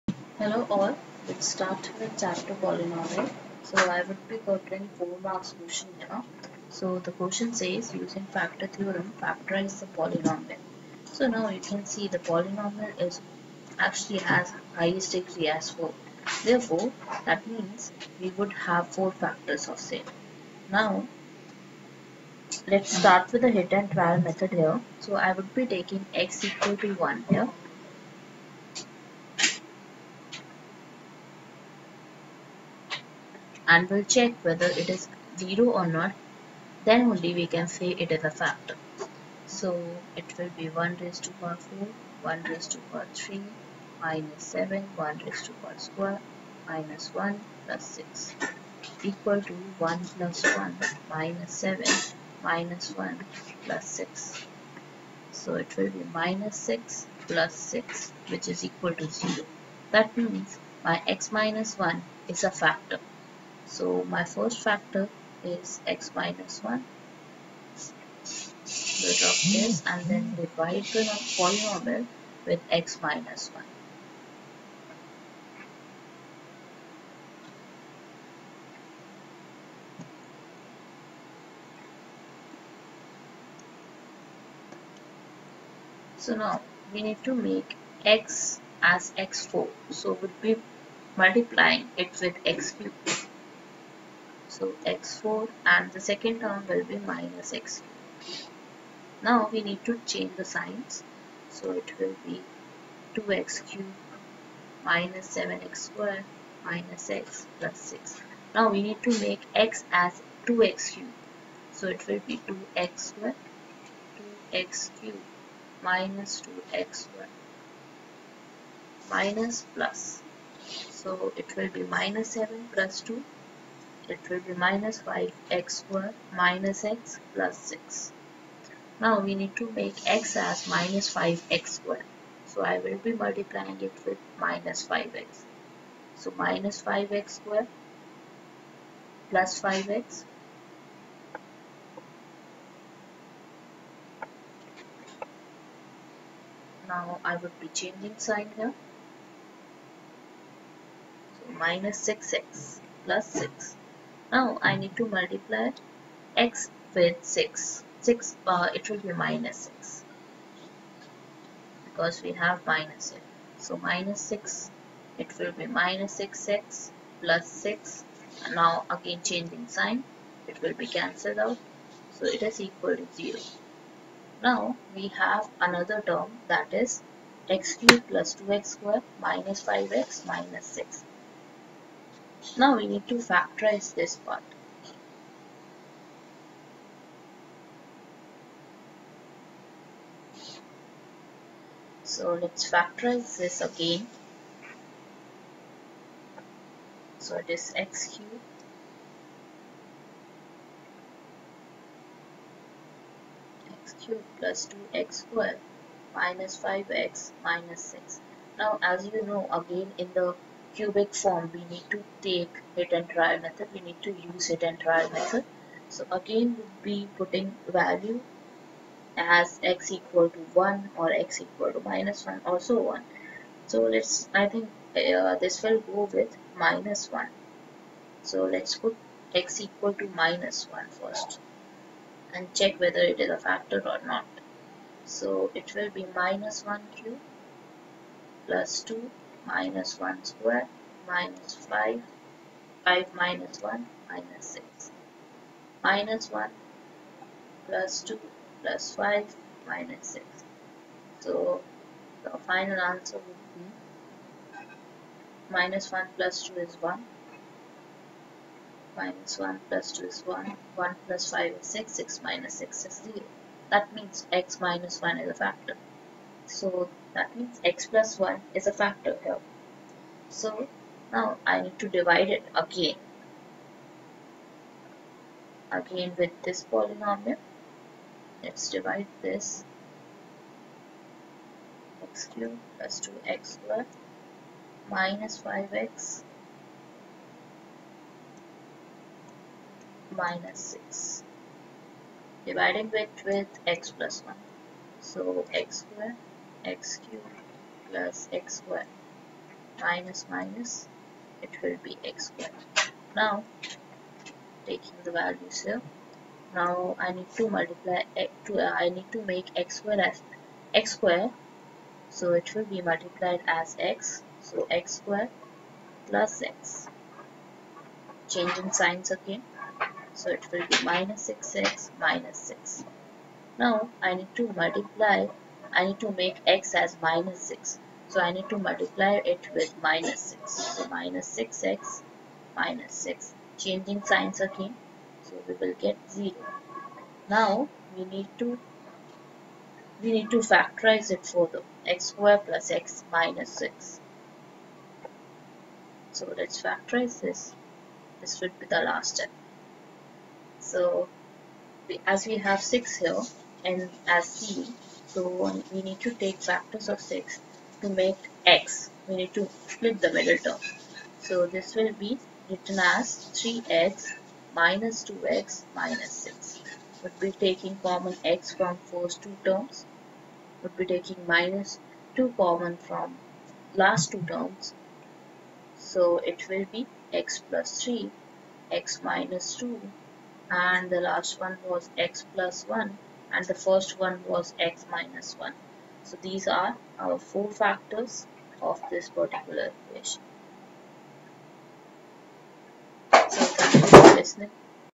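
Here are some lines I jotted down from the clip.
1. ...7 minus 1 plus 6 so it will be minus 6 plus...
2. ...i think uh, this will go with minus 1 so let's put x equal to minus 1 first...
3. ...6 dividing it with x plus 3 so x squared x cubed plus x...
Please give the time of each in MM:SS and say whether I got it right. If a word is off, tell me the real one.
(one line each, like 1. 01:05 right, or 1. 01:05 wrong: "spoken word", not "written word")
1. 00:51 right
2. 03:44 right
3. 04:50 wrong: "1", not "3".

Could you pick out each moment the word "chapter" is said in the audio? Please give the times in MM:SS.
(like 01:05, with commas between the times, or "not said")
00:02.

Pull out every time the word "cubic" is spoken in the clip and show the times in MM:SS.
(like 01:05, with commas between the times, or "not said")
03:30.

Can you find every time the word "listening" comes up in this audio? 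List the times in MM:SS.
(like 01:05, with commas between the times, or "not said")
06:34.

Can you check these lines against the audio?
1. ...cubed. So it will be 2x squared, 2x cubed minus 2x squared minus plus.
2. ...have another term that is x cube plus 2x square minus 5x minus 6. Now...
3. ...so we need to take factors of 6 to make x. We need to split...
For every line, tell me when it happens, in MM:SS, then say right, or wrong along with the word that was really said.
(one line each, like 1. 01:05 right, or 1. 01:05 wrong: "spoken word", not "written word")
1. 01:50 right
2. 02:55 right
3. 05:55 right.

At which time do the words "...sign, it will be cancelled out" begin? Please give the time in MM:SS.
02:49.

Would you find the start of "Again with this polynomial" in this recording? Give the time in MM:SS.
04:35.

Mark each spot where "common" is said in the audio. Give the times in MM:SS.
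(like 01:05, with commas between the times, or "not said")
06:07, 06:12.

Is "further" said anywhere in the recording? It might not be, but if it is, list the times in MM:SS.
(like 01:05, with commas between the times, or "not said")
05:41.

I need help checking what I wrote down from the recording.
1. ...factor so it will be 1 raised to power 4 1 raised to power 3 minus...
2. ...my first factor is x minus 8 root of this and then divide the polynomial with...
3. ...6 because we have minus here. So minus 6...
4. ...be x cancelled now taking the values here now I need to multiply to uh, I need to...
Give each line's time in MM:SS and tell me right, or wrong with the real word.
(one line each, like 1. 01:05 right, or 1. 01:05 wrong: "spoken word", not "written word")
1. 00:38 right
2. 01:04 wrong: "1", not "8"
3. 02:39 right
4. 05:01 wrong: "squared", not "cancelled".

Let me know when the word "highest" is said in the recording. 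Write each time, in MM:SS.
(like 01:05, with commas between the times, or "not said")
00:14.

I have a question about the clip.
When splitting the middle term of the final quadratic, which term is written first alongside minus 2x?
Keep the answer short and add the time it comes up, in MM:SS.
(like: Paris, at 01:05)
3x, at 06:03.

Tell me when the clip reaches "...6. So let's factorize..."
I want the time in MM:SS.
05:43.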